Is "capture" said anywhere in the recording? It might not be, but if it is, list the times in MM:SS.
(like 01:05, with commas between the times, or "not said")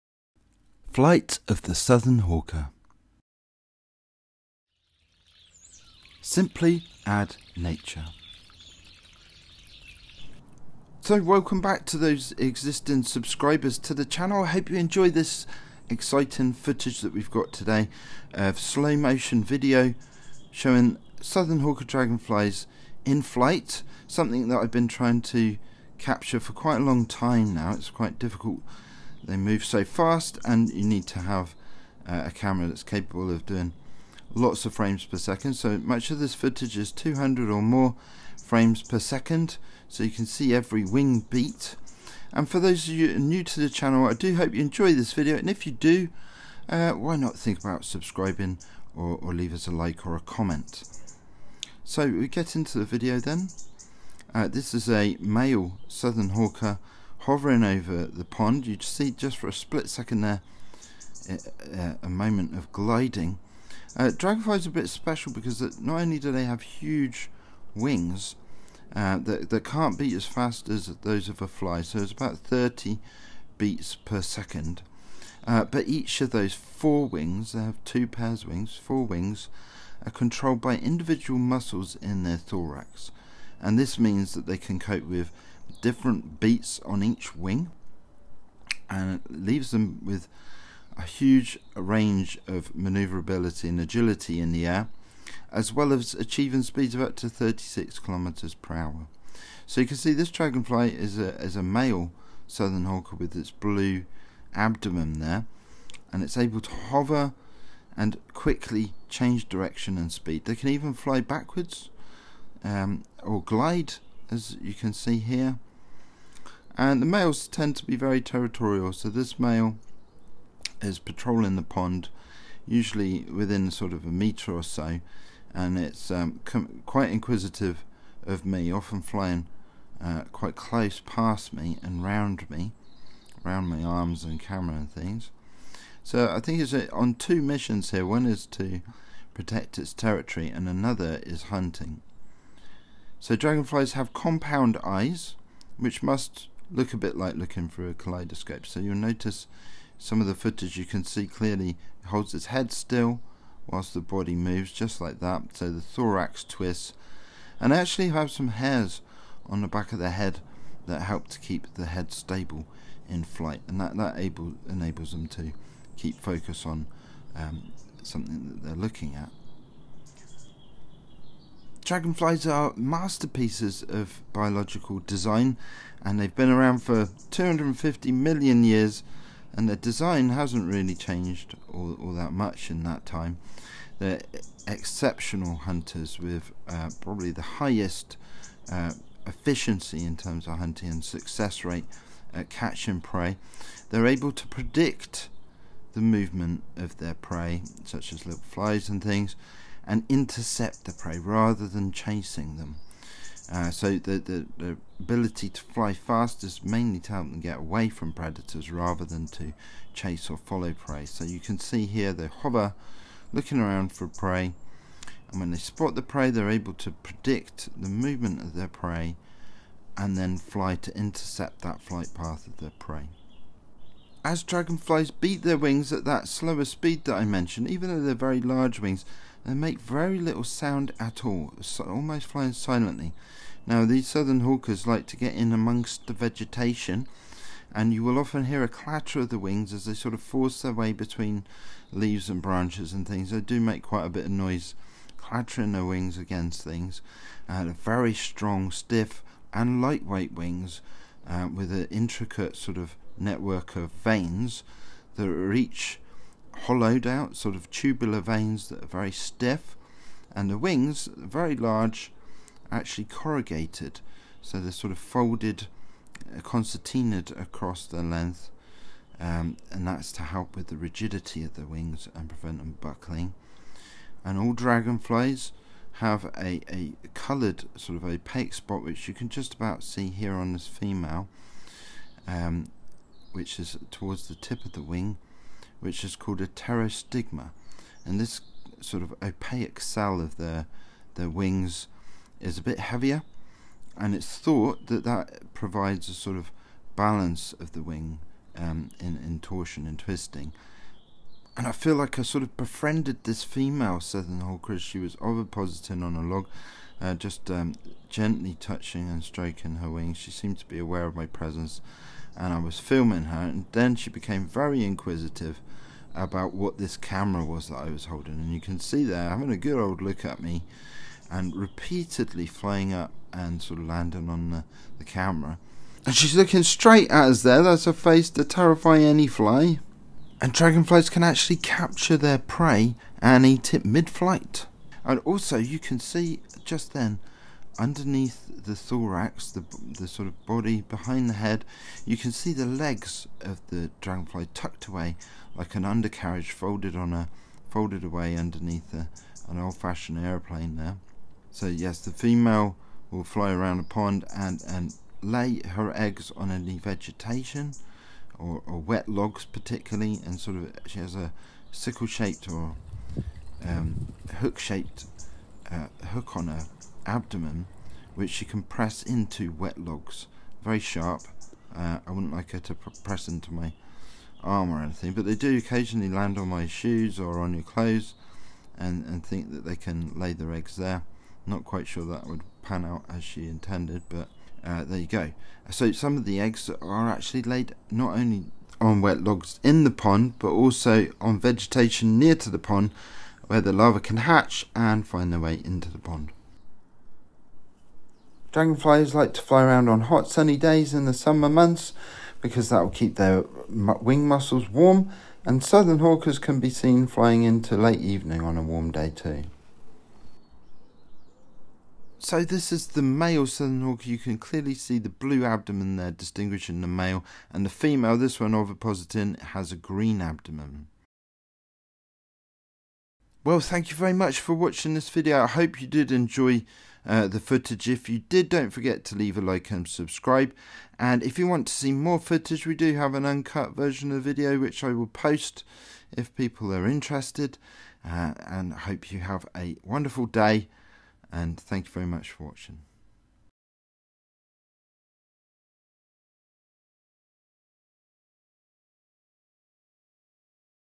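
00:25, 05:31.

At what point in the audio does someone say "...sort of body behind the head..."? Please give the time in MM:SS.
05:40.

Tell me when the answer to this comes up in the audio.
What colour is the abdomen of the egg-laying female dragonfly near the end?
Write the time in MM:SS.
06:59.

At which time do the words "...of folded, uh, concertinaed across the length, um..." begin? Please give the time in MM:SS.
04:24.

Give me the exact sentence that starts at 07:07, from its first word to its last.
If you did, don't forget to leave a like and subscribe.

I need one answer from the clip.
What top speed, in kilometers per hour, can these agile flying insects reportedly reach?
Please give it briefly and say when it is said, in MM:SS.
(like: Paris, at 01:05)
36 kilometers per hour, at 01:37.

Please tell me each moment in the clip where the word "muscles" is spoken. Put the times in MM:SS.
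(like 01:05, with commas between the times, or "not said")
01:21, 06:44.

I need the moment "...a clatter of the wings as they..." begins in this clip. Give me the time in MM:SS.
03:58.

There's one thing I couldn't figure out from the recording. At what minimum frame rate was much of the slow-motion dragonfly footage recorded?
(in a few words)
200.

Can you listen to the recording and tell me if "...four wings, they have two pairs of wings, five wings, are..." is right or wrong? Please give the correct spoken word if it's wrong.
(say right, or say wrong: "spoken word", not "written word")
wrong: "four", not "five".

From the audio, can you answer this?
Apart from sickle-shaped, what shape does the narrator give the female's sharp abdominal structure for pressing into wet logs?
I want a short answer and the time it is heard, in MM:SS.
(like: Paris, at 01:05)
Hook-shaped, at 06:04.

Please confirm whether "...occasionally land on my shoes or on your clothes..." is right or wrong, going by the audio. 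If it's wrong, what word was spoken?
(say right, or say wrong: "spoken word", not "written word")
right.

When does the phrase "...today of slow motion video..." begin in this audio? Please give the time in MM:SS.
00:17.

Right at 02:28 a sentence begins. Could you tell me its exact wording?
So you'll notice some of the footage you can see clearly holds its head still whilst the body moves just like that.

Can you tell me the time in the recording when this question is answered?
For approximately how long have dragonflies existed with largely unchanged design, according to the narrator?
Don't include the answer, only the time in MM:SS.
02:57.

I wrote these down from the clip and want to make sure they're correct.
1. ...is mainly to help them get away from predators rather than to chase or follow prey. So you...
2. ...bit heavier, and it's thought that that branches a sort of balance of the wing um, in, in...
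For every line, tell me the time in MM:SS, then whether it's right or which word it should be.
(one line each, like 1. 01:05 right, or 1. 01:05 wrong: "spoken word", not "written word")
1. 03:26 right
2. 04:52 wrong: "provides", not "branches".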